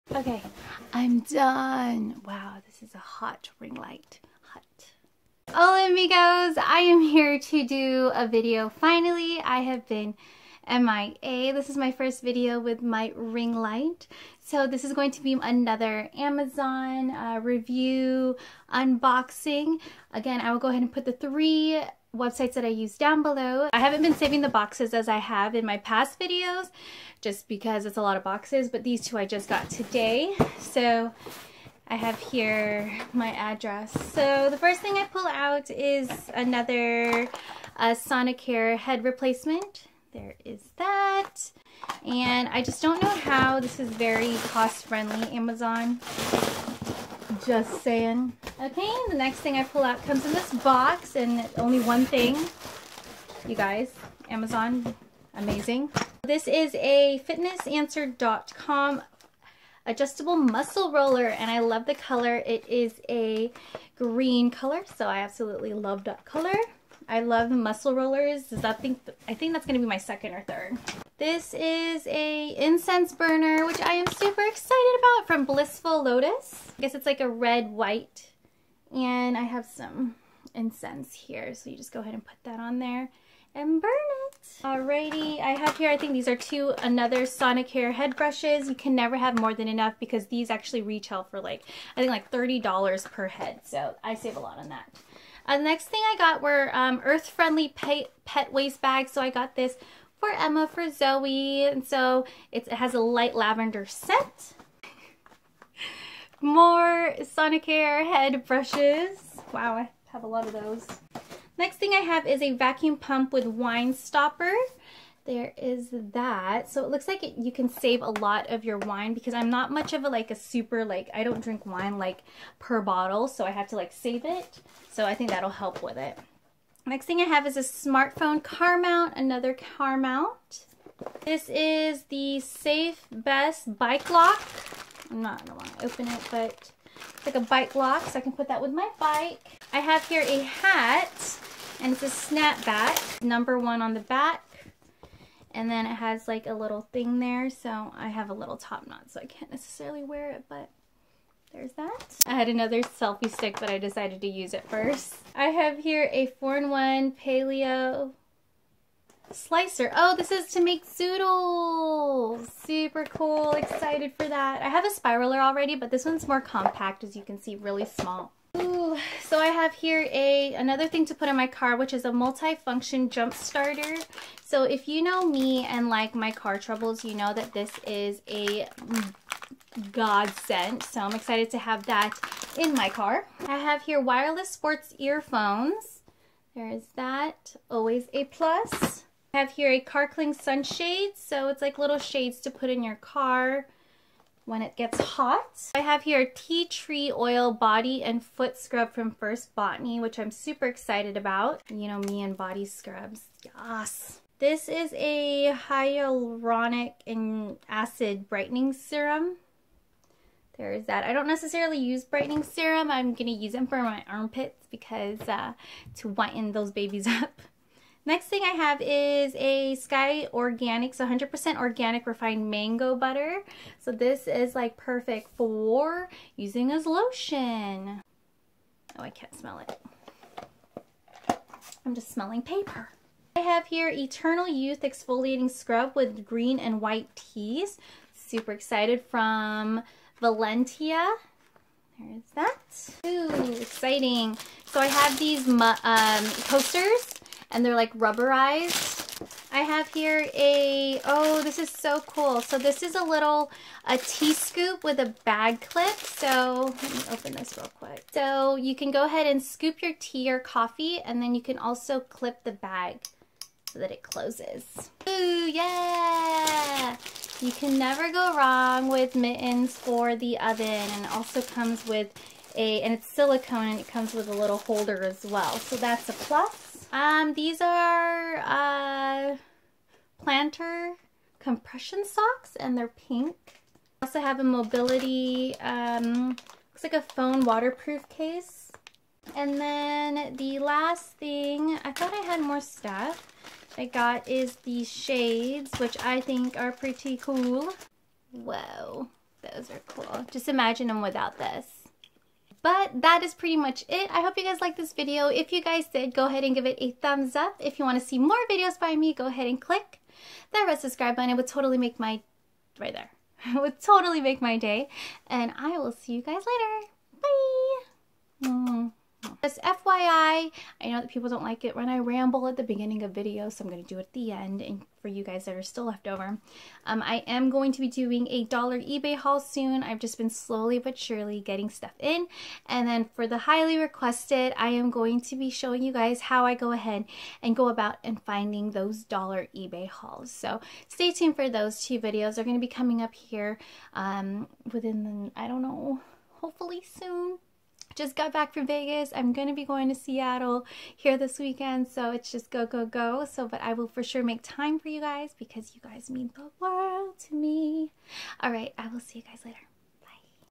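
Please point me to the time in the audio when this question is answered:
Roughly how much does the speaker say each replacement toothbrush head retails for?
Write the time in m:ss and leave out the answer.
1:32.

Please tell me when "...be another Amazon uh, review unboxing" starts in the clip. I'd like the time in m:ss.
0:15.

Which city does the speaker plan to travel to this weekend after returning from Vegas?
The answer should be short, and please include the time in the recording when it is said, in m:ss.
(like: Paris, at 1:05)
Seattle, at 5:49.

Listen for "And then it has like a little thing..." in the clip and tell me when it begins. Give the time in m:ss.
2:25.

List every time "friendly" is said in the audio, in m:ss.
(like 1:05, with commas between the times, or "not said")
0:44, 1:37.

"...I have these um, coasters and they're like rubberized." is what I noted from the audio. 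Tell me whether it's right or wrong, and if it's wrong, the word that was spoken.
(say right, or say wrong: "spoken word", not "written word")
right.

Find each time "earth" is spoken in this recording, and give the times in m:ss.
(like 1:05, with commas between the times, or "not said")
1:37.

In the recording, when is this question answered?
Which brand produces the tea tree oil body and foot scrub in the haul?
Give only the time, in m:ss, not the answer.
3:19.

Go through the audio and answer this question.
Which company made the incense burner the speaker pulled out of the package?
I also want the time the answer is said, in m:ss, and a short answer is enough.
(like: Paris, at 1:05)
Blissful Lotus, at 1:15.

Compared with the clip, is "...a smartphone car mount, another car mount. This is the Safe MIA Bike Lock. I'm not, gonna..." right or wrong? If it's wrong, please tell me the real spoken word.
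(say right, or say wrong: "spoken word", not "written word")
wrong: "Best", not "MIA".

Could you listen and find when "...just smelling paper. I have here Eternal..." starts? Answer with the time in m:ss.
3:51.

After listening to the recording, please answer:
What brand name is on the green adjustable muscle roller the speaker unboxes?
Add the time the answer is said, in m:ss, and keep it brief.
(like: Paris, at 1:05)
fitnessanswer.com, at 0:57.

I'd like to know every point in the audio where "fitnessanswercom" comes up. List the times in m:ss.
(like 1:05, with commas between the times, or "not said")
0:57.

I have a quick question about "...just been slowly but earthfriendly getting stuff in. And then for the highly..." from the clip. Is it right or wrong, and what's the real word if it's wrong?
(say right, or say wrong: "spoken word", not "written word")
wrong: "surely", not "earthfriendly".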